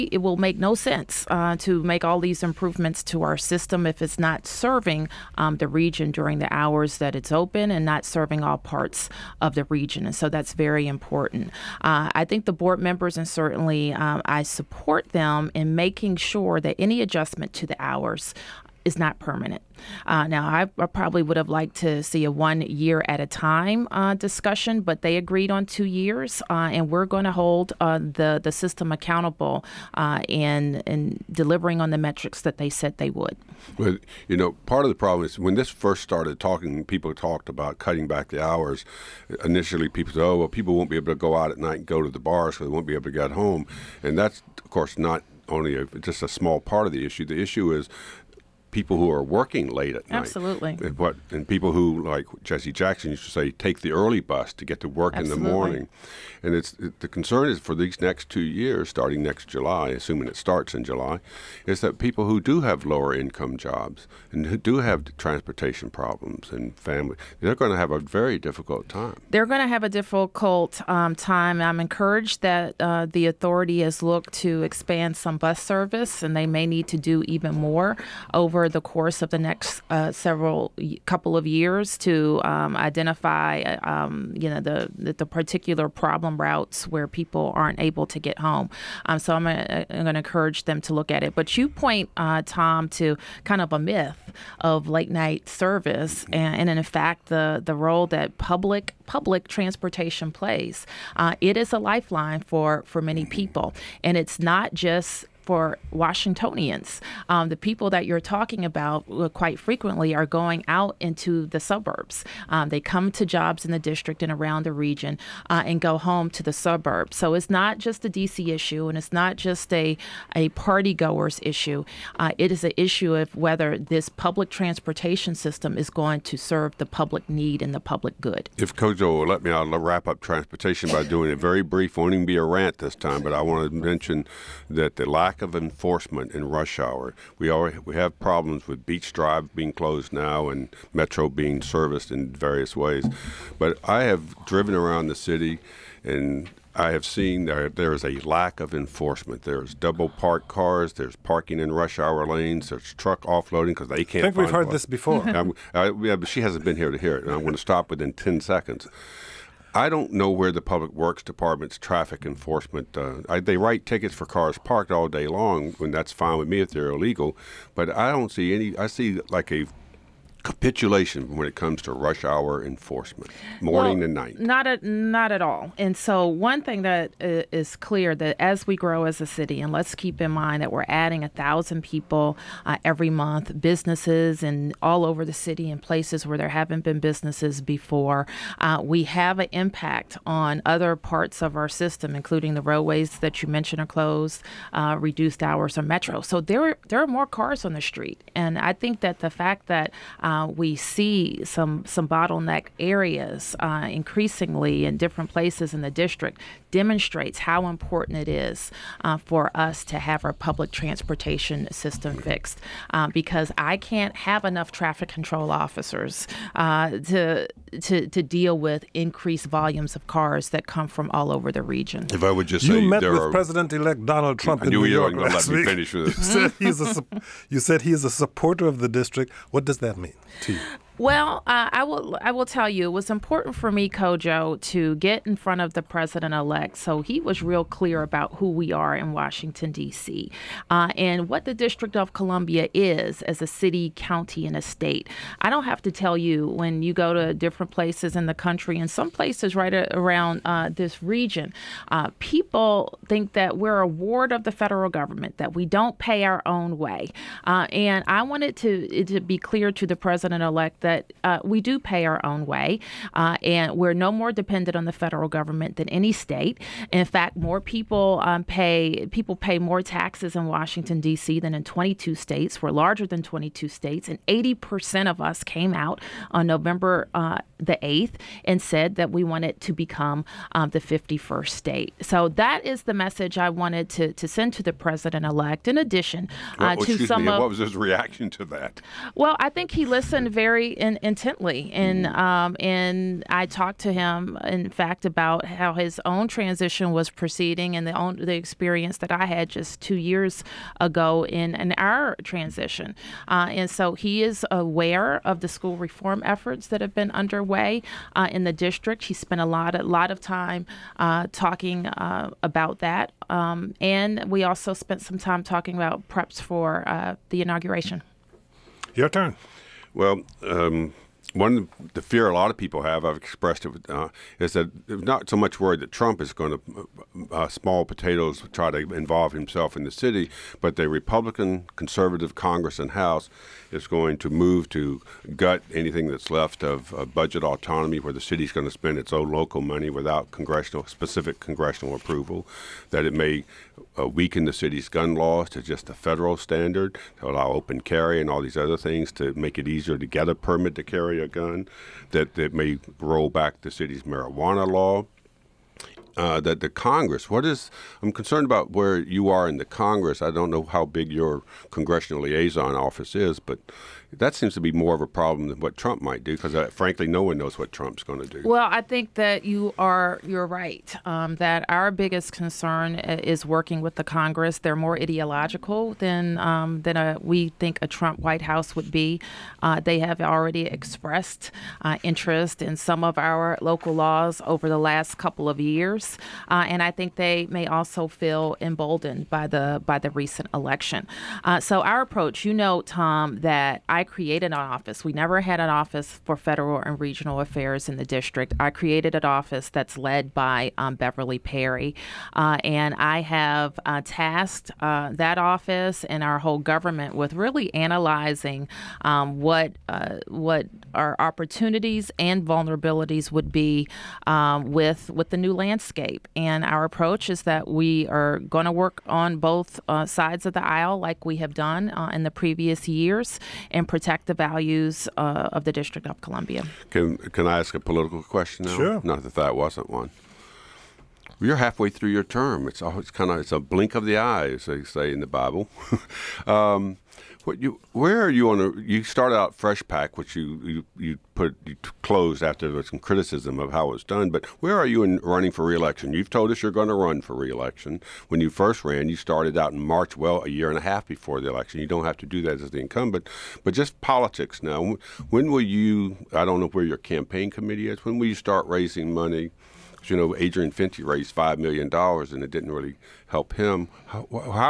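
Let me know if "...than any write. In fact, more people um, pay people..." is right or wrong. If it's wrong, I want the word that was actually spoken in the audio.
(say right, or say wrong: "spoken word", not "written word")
wrong: "state", not "write".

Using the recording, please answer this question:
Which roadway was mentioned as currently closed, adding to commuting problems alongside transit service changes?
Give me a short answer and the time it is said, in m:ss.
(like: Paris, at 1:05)
Beach Drive, at 2:18.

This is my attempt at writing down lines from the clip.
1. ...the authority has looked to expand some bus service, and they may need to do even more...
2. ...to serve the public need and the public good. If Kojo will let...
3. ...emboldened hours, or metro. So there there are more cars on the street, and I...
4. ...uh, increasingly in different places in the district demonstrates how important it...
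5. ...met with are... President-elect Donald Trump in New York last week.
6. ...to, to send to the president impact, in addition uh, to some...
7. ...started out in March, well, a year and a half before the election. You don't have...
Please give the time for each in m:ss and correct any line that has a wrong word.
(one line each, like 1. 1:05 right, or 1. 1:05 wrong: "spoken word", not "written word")
1. 1:13 right
2. 2:06 right
3. 3:14 wrong: "reduced", not "emboldened"
4. 3:23 right
5. 3:42 right
6. 4:43 wrong: "elect", not "impact"
7. 7:29 right.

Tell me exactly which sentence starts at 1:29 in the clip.
Um, so I'm going to encourage them to look at it.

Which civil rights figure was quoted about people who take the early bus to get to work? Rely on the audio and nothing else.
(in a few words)
Jesse Jackson.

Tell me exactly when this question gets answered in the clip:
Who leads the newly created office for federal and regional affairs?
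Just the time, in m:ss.
6:40.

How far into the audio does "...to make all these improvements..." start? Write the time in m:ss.
0:01.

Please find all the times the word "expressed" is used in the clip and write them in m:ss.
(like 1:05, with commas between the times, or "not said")
5:23, 6:20.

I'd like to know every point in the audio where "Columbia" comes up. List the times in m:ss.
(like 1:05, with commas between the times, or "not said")
4:02, 7:06.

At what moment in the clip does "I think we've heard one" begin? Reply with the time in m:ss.
2:34.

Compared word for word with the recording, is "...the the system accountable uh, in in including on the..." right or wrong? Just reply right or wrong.
wrong.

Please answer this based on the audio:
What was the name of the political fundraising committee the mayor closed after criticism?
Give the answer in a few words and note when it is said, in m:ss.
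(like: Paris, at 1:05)
FreshPAC, at 7:19.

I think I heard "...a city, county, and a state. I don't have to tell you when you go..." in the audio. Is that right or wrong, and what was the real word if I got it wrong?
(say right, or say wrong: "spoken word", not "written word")
right.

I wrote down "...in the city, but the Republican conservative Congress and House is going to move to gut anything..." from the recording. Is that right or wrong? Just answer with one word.
right.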